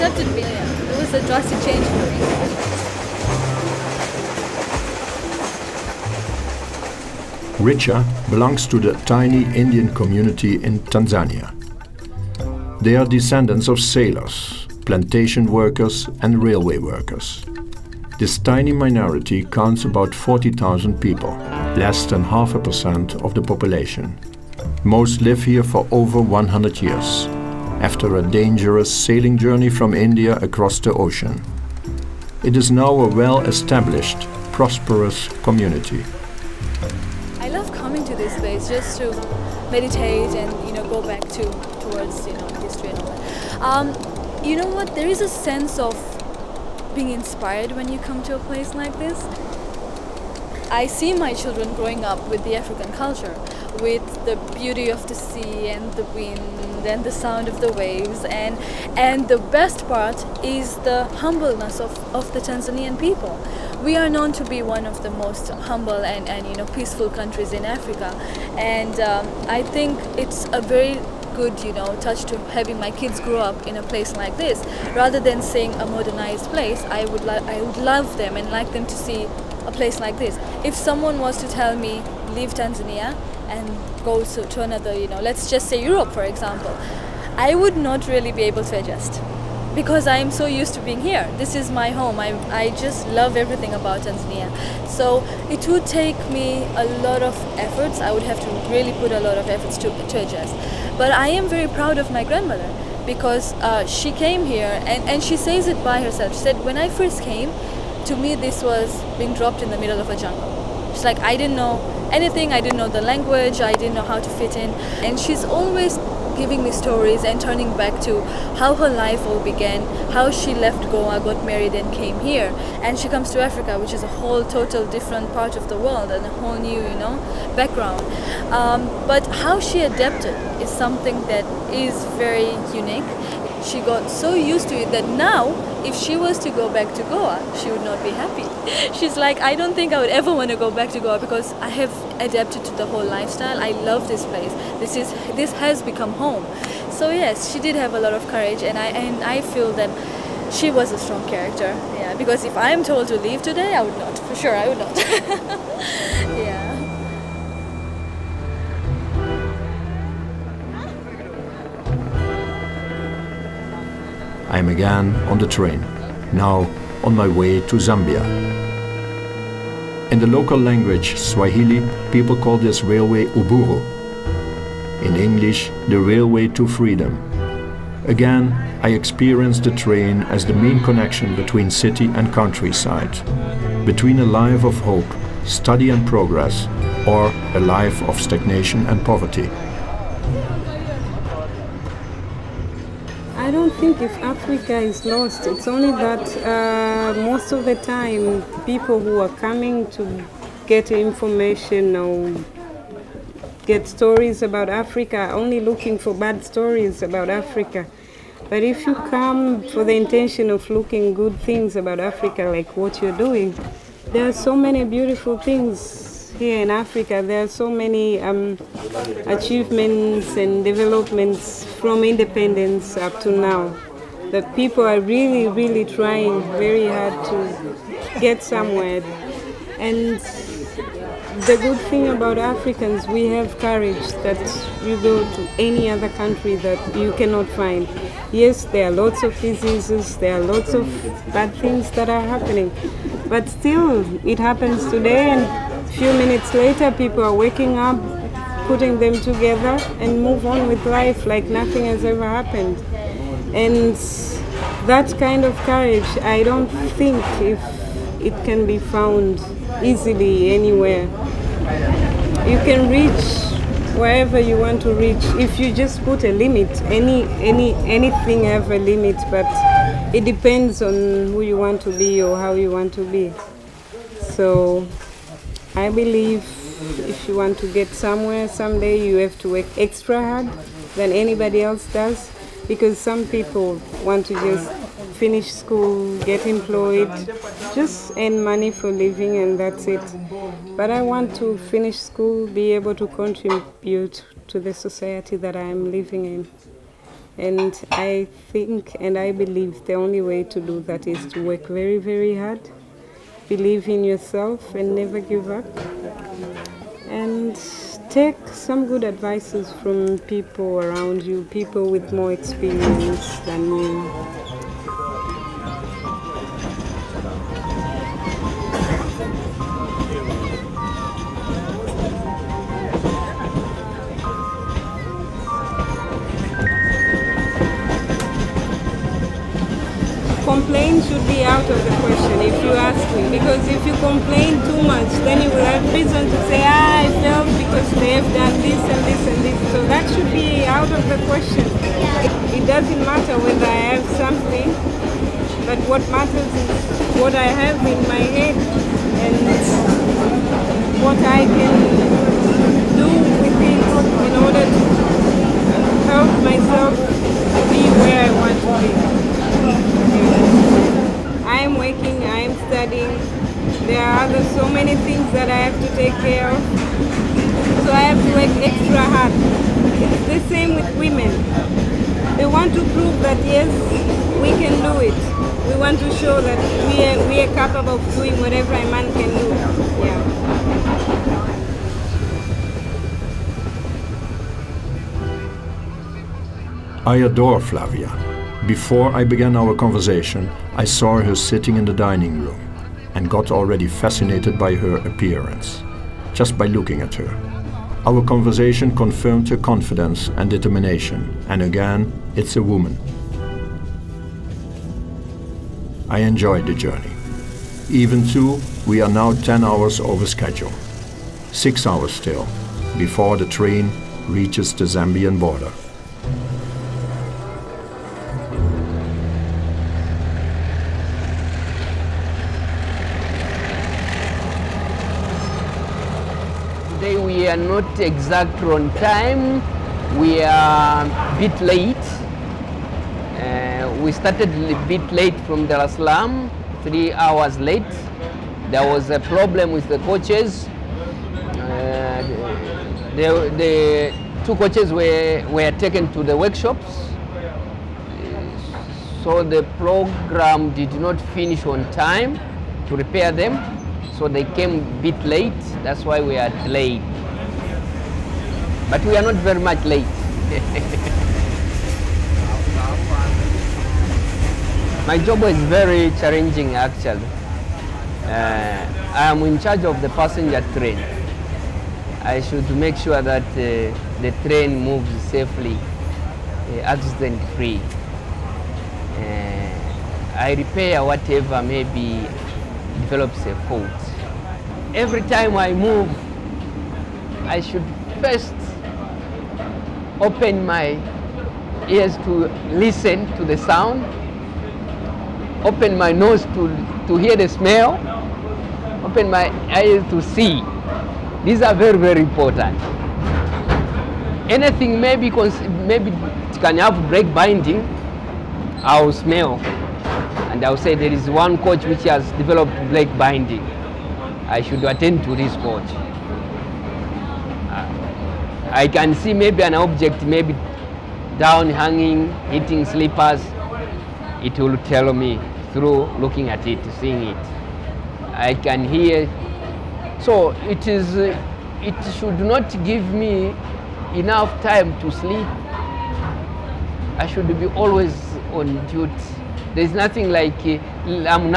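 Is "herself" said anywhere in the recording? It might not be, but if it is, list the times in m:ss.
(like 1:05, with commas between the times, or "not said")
1:46.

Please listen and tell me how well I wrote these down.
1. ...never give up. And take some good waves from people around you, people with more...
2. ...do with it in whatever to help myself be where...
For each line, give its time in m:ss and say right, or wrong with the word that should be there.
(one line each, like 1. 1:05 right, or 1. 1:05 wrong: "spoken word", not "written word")
1. 5:04 wrong: "advices", not "waves"
2. 5:52 wrong: "order", not "whatever".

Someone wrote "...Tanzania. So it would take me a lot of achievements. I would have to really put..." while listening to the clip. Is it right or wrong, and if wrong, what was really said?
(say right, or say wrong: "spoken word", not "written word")
wrong: "efforts", not "achievements".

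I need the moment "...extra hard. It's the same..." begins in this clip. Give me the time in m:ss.
6:08.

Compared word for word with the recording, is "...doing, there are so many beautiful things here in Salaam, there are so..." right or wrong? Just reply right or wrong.
wrong.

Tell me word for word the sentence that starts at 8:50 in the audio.
So it is, it should not give me enough time to sleep.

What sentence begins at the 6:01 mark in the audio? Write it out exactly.
I am working, I am studying.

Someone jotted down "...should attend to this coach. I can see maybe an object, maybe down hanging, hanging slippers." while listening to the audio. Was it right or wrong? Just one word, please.
wrong.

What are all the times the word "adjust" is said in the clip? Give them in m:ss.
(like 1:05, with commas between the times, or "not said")
1:28, 1:40.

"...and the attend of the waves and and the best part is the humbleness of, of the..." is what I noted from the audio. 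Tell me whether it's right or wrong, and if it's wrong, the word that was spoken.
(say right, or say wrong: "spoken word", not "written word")
wrong: "sound", not "attend".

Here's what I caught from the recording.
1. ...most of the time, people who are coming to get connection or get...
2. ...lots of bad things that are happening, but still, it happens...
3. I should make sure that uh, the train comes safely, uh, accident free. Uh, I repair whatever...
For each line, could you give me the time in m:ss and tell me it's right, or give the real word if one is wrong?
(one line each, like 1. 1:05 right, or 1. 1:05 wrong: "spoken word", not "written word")
1. 3:17 wrong: "information", not "connection"
2. 4:00 right
3. 7:52 wrong: "moves", not "comes".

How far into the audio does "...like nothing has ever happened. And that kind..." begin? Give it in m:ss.
4:11.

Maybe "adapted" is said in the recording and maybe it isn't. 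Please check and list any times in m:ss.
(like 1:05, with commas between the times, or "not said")
2:09, 2:22.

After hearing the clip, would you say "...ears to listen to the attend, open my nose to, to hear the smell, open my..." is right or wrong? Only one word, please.
wrong.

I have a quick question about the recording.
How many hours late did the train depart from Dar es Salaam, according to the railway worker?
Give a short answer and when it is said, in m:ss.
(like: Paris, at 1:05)
3, at 7:16.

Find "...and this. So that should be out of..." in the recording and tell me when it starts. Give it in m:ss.
5:39.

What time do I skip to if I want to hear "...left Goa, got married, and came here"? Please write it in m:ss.
2:00.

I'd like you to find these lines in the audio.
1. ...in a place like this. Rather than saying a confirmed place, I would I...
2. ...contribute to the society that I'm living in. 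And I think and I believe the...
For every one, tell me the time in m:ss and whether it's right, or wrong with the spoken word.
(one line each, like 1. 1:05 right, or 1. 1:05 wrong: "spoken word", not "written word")
1. 1:13 wrong: "modernized", not "confirmed"
2. 4:53 right.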